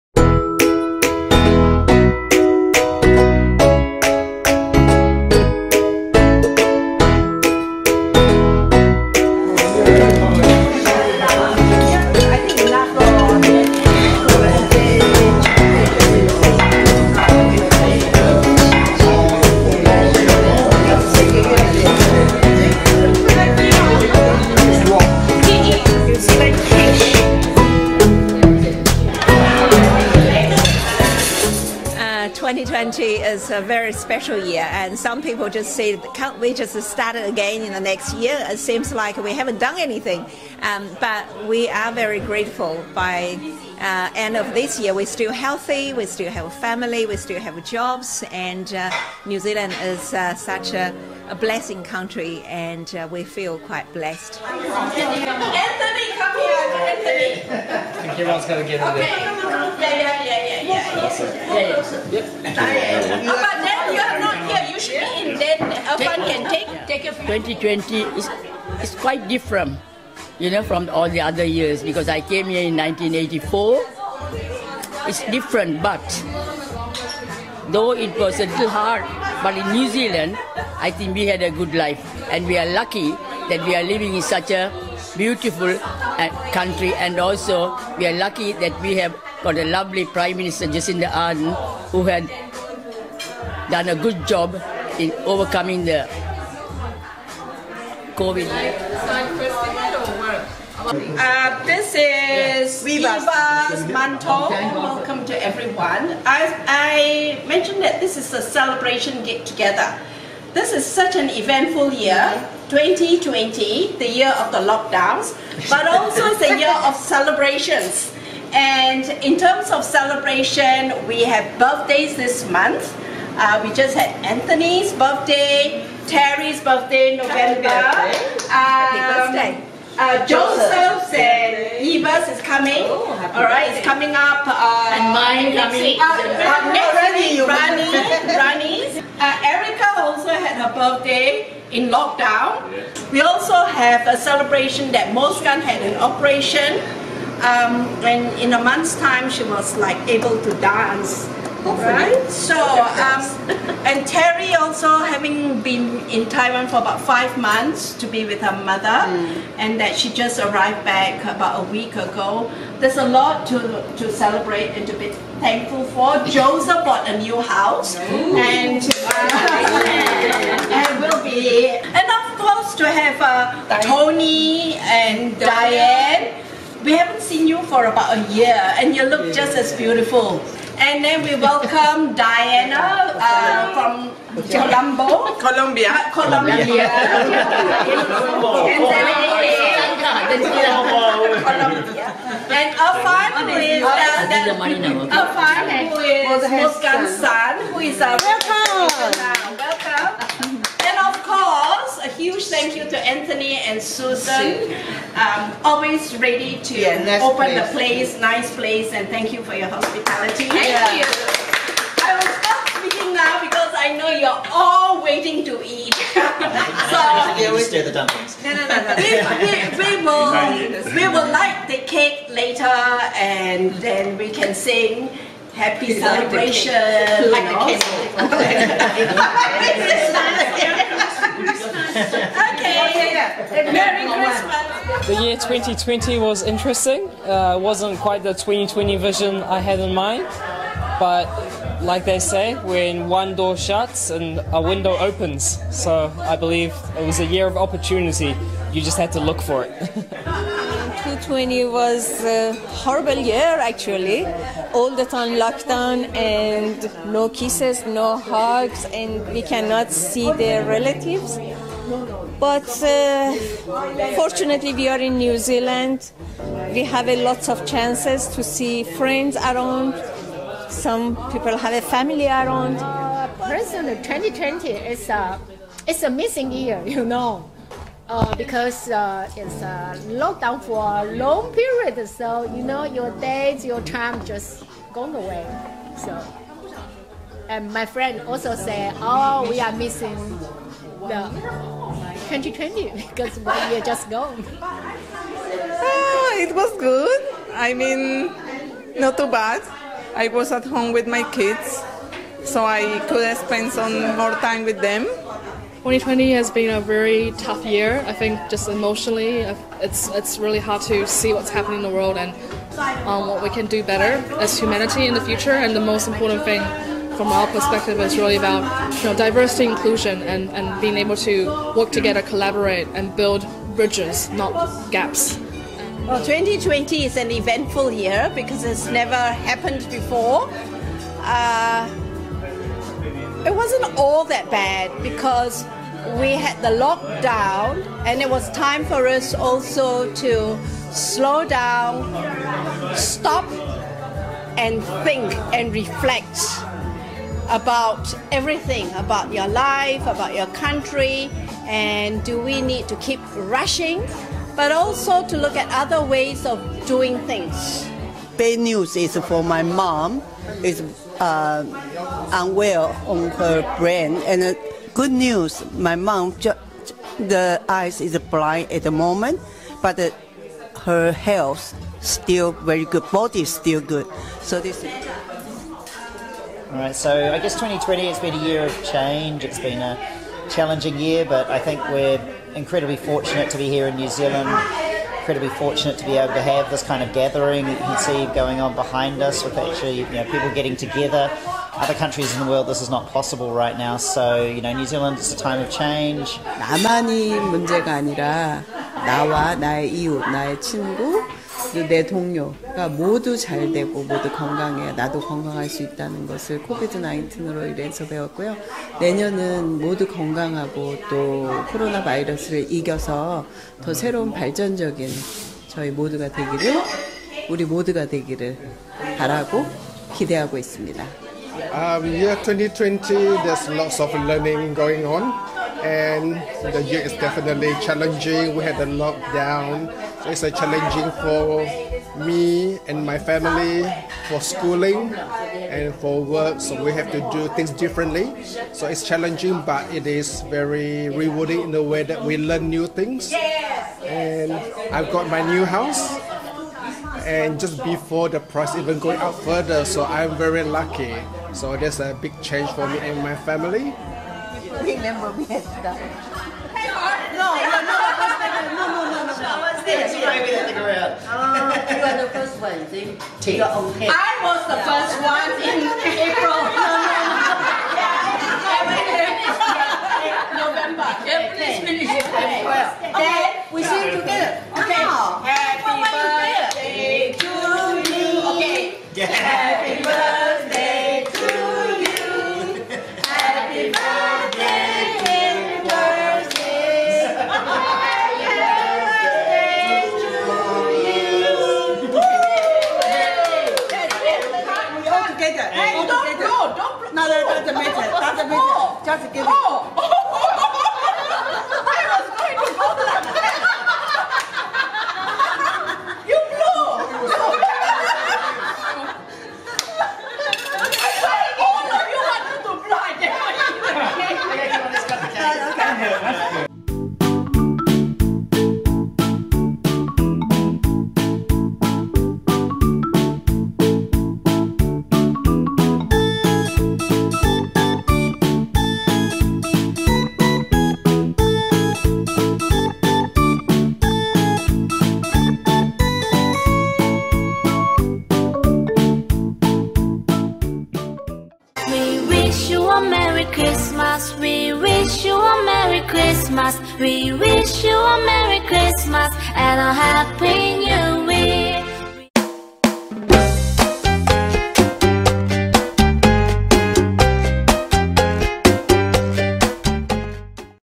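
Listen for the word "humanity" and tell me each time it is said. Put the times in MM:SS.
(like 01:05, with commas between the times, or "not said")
05:14.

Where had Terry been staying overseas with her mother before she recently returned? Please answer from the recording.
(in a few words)
Taiwan.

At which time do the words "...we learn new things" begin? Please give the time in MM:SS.
07:22.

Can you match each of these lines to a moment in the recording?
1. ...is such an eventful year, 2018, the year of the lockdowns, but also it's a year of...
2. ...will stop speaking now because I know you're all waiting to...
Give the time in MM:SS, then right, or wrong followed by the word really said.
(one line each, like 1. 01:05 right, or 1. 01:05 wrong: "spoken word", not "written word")
1. 01:50 wrong: "2020", not "2018"
2. 03:32 right.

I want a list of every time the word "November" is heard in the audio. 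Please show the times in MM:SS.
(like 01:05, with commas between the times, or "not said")
02:07, 07:52.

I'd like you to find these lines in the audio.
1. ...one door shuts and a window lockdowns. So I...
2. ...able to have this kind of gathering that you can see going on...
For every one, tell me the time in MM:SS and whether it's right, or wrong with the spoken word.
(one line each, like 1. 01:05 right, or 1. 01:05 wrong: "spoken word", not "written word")
1. 04:03 wrong: "opens", not "lockdowns"
2. 06:26 right.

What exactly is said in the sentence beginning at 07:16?
So we have to do things differently.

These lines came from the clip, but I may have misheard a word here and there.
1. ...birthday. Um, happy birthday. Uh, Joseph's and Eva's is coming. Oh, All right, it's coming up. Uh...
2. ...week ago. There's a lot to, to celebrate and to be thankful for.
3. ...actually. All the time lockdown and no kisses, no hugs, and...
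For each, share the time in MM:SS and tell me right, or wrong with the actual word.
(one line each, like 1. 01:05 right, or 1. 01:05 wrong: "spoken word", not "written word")
1. 02:08 right
2. 02:41 right
3. 04:13 right.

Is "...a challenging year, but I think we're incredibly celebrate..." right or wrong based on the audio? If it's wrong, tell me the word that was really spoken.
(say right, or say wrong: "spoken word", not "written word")
wrong: "fortunate", not "celebrate".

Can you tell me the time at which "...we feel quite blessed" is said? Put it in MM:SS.
00:53.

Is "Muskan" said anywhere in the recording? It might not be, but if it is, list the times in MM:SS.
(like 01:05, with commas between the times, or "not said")
02:25, 03:16.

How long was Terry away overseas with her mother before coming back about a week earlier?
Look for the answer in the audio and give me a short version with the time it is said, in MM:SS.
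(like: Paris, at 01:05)
about five months, at 02:36.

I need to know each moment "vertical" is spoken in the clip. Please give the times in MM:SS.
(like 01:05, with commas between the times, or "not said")
not said.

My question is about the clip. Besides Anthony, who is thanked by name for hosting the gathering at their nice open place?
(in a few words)
Susan.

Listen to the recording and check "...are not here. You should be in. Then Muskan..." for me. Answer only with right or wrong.
wrong.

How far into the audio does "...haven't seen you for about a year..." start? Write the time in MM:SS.
02:56.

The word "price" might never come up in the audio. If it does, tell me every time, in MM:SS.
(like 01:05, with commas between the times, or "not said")
07:28.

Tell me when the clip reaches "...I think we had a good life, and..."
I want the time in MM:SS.
01:20.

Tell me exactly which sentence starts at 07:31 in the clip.
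So there's a big change for me and my family.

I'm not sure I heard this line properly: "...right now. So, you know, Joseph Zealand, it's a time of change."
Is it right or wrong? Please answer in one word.
wrong.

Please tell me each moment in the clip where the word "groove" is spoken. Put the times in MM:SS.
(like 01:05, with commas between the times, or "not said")
not said.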